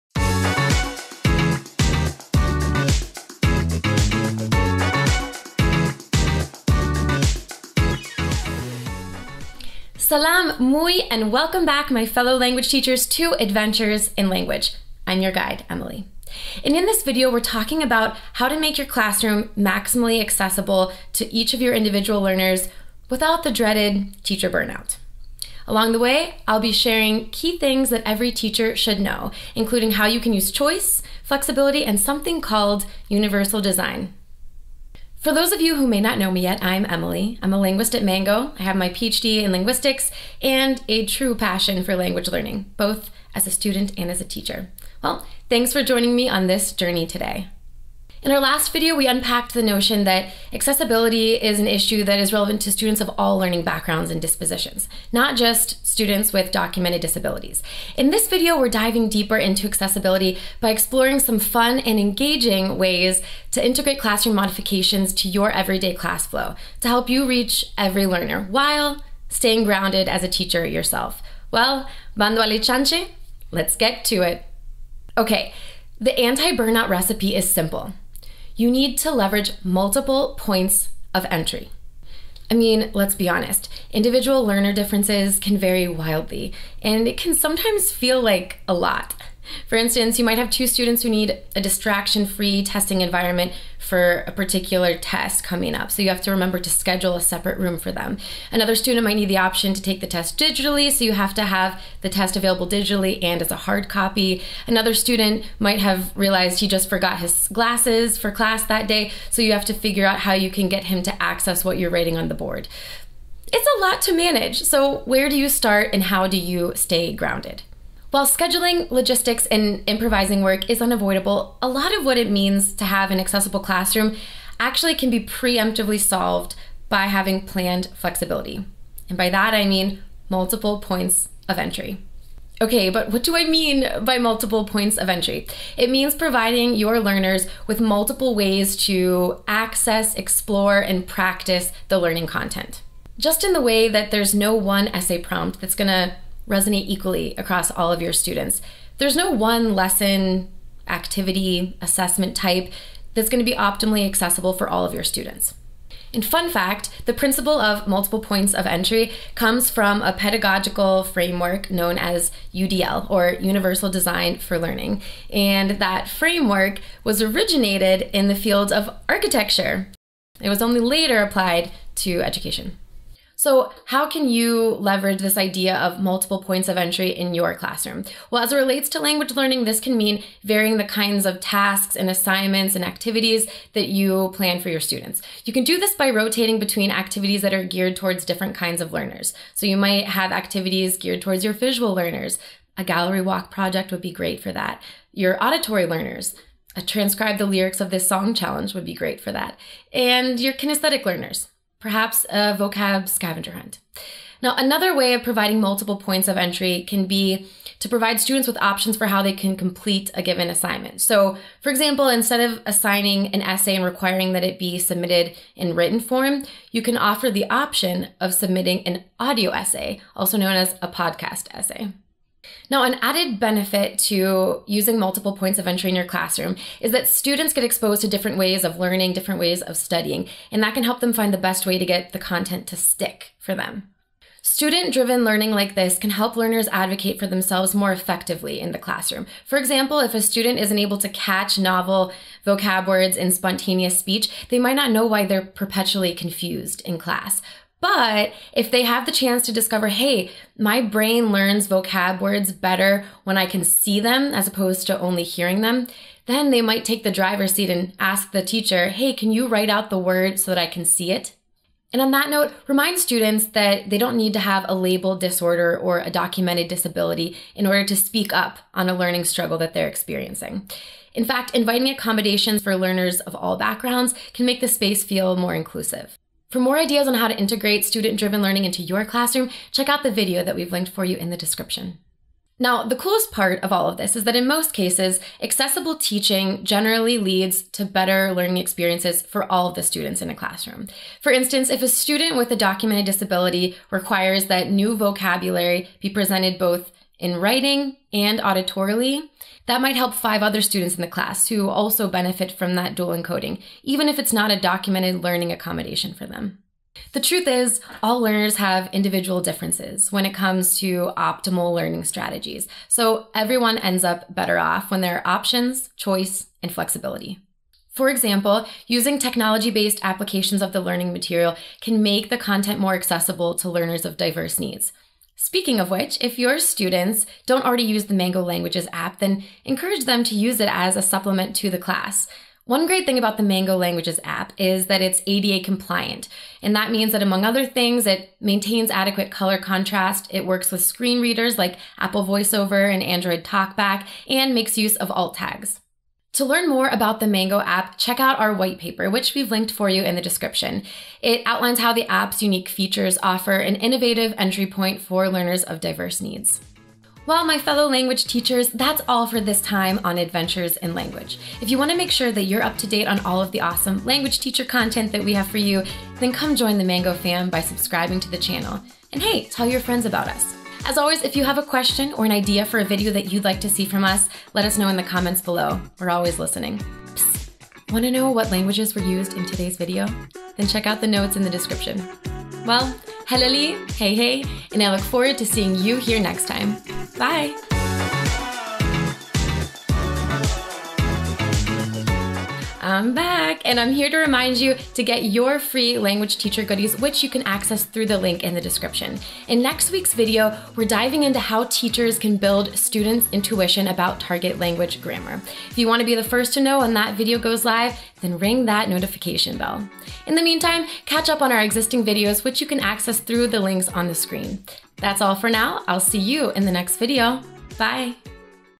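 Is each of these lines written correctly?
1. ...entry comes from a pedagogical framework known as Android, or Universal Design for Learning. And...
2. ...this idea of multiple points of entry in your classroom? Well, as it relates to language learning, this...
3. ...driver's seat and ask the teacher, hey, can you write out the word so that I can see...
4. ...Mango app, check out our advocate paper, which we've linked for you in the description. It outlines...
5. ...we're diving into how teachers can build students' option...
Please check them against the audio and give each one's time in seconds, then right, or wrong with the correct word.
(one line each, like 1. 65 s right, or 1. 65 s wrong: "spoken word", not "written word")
1. 158 s wrong: "UDL", not "Android"
2. 175 s right
3. 257 s right
4. 347 s wrong: "white", not "advocate"
5. 400 s wrong: "intuition", not "option".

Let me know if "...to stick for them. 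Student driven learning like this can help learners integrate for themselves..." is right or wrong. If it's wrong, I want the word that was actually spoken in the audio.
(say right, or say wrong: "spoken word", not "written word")
wrong: "advocate", not "integrate".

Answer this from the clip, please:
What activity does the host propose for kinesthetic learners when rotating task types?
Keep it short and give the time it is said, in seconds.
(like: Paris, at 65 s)
vocab scavenger hunt, at 202 s.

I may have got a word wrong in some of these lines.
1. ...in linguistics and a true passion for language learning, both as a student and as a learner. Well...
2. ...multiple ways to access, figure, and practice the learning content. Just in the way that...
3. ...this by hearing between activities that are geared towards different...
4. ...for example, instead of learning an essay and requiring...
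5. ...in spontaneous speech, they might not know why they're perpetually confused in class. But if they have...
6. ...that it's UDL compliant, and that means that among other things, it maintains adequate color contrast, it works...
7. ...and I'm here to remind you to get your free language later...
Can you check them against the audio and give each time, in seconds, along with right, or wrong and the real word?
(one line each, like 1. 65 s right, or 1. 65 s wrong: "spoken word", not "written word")
1. 39 s wrong: "teacher", not "learner"
2. 137 s wrong: "explore", not "figure"
3. 185 s wrong: "rotating", not "hearing"
4. 211 s wrong: "assigning", not "learning"
5. 243 s right
6. 334 s wrong: "ADA", not "UDL"
7. 393 s wrong: "teacher", not "later".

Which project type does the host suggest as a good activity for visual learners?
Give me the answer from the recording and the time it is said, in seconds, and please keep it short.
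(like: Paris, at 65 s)
gallery walk, at 192 s.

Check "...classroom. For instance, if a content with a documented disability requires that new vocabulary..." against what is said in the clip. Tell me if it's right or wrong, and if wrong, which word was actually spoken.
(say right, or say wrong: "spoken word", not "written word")
wrong: "student", not "content".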